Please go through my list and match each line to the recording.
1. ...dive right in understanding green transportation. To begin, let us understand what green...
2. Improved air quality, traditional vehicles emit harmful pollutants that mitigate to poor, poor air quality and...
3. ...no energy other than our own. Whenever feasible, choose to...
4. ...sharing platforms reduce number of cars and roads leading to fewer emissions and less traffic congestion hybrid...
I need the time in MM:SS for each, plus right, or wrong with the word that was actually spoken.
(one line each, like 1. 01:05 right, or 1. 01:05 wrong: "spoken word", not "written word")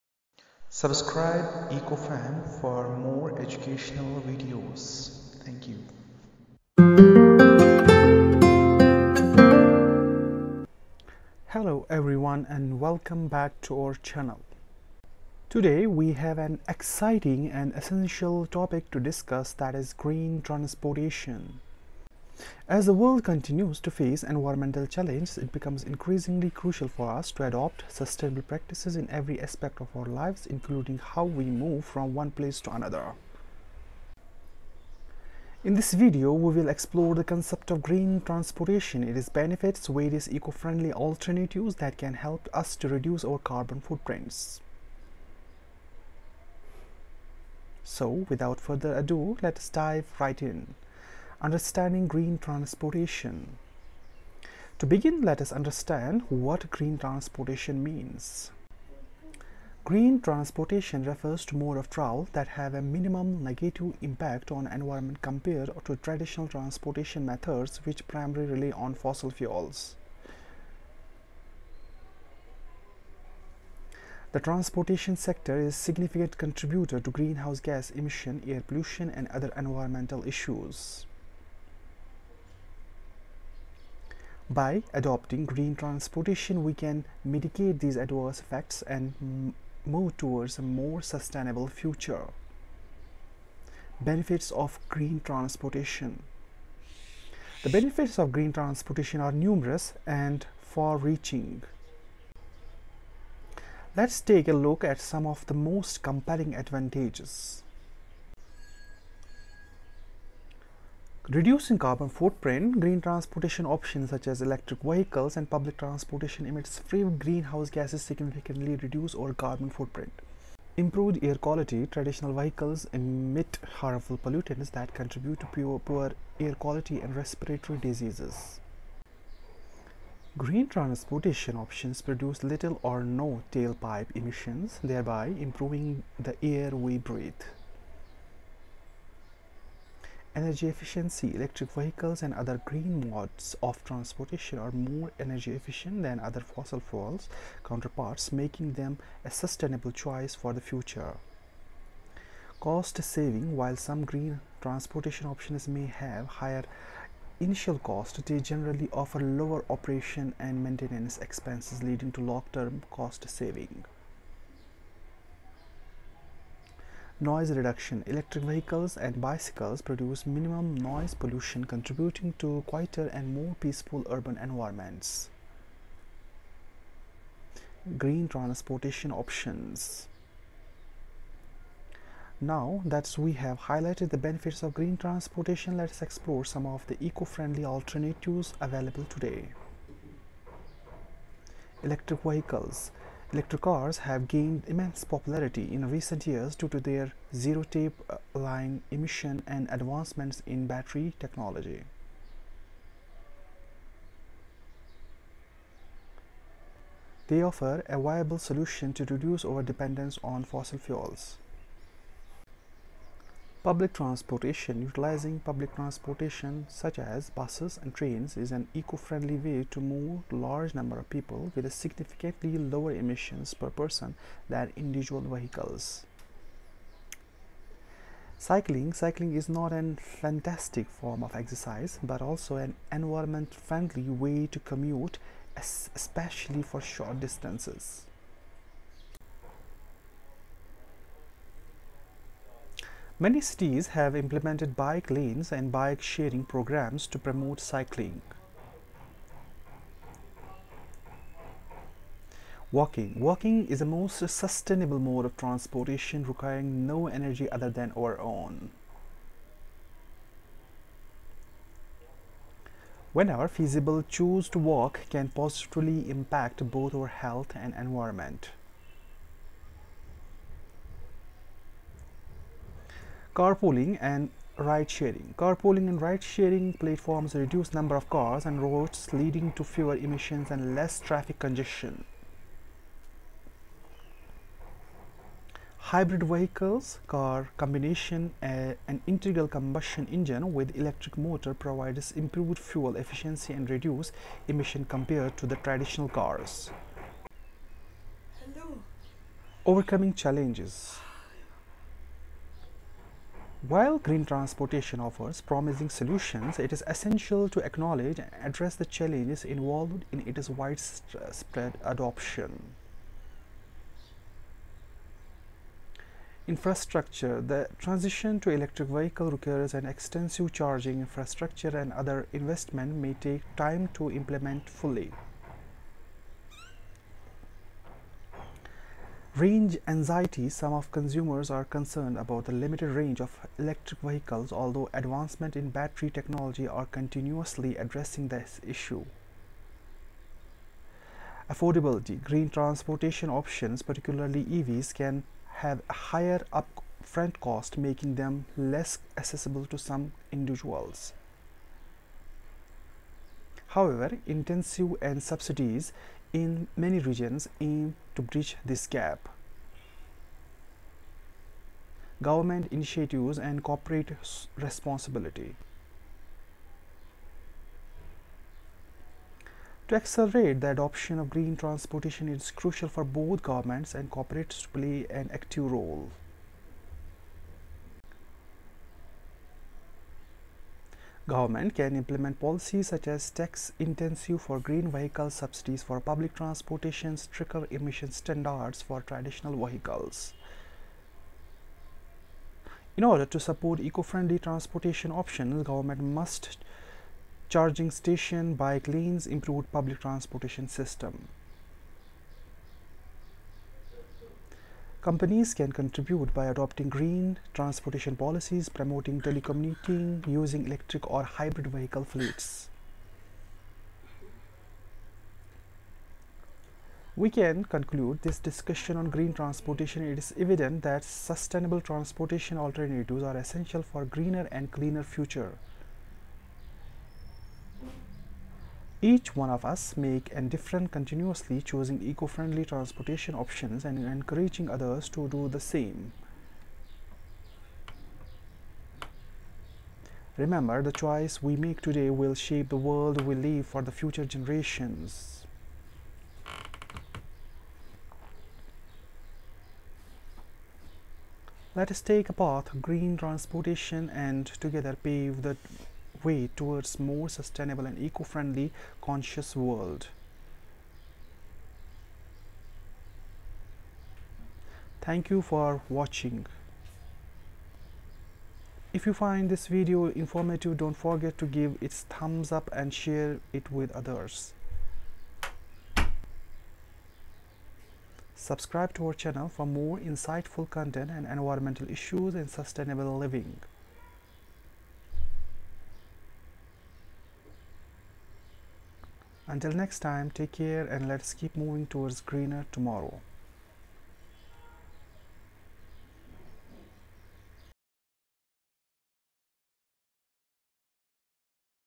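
1. 00:49 right
2. 02:00 wrong: "contribute", not "mitigate"
3. 04:16 right
4. 04:36 right.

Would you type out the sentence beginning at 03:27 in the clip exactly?
They offer a viable solution to reduce our dependence on fossil fuels.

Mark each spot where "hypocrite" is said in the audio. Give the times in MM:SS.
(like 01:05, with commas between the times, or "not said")
not said.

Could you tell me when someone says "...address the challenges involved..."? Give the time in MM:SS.
05:08.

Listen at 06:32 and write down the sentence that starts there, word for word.
In order to support eco-friendly transportation options, government must charging station, bike lanes, improved public transportation system.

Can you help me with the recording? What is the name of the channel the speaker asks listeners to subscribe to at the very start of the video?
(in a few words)
EcoFAM.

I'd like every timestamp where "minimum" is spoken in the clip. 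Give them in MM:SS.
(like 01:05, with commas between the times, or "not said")
01:02, 02:50.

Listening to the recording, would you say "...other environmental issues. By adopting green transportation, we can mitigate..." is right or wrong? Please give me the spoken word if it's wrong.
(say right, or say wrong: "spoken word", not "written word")
right.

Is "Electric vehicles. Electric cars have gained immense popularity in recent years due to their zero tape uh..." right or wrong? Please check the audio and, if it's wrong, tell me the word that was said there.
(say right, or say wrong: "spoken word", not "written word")
right.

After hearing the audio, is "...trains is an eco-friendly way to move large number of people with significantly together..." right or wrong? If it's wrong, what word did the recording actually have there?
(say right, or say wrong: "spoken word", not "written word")
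wrong: "lower", not "together".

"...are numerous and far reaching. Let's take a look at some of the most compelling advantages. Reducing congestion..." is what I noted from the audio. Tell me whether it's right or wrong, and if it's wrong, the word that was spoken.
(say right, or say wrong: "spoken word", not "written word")
wrong: "carbon", not "congestion".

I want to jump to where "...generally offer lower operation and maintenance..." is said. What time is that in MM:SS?
02:38.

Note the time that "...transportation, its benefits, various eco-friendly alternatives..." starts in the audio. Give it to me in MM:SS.
00:38.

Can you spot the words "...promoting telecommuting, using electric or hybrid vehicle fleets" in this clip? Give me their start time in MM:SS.
06:48.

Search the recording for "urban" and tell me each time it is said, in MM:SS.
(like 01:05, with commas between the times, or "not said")
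02:54.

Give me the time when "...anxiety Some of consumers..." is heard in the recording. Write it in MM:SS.
05:29.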